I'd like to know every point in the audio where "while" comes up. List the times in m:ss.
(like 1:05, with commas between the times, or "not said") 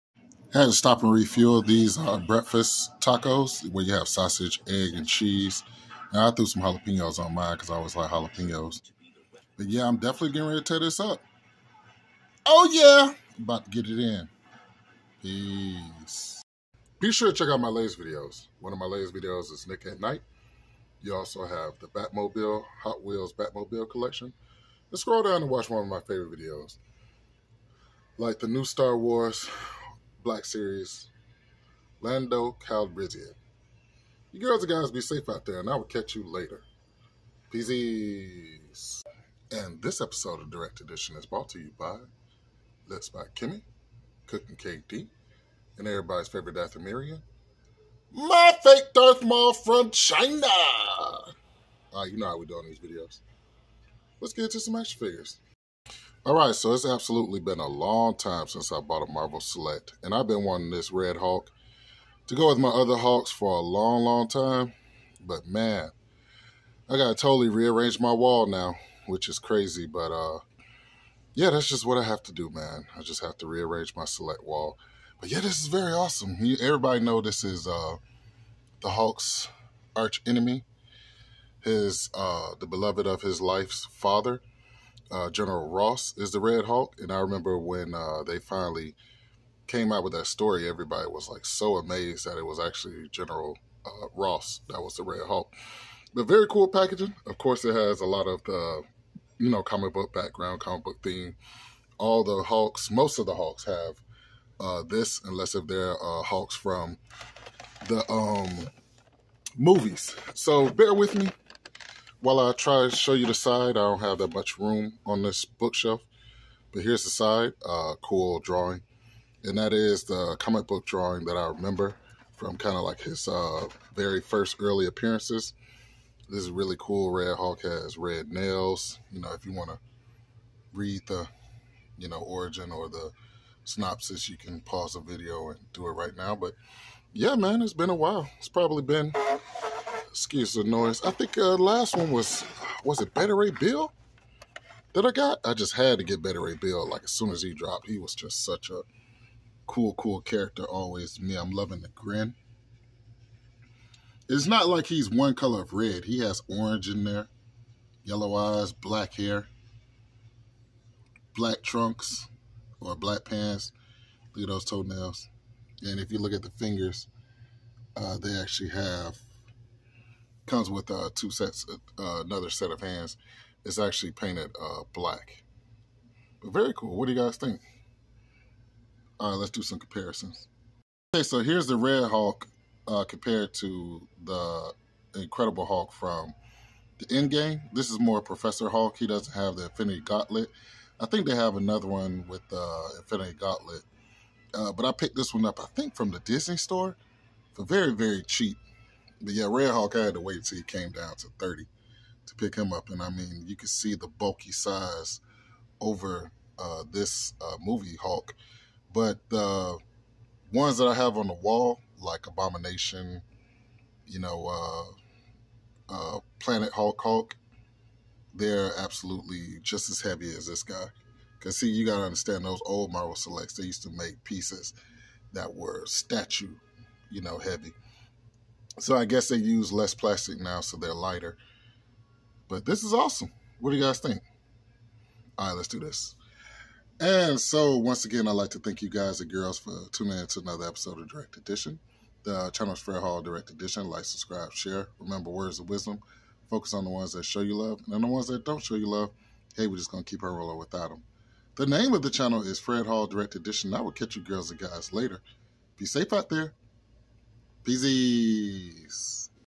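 1:52, 2:17.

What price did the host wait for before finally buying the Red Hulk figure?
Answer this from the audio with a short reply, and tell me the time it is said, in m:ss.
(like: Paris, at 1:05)
30, at 3:21.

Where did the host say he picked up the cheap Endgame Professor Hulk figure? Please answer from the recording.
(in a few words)
Disney store.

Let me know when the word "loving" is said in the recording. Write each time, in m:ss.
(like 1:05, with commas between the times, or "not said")
2:31.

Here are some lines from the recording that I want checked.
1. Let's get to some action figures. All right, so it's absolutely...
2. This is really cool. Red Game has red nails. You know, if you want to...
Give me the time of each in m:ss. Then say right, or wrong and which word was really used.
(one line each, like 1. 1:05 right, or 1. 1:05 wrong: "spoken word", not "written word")
1. 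0:54 right
2. 2:06 wrong: "Hulk", not "Game".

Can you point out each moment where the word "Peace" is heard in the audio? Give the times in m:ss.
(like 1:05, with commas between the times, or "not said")
0:15, 0:37, 4:17.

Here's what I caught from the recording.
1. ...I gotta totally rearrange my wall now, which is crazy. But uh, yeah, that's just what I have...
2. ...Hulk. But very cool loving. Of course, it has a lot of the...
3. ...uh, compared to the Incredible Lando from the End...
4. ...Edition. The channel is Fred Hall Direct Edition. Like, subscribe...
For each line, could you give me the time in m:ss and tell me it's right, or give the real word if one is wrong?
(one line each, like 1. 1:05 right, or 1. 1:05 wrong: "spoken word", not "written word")
1. 1:06 right
2. 1:35 wrong: "packaging", not "loving"
3. 3:02 wrong: "Hulk", not "Lando"
4. 4:01 right.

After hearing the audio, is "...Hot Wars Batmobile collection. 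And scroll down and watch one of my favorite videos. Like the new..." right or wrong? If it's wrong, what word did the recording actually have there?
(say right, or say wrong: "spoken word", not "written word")
wrong: "Wheels", not "Wars".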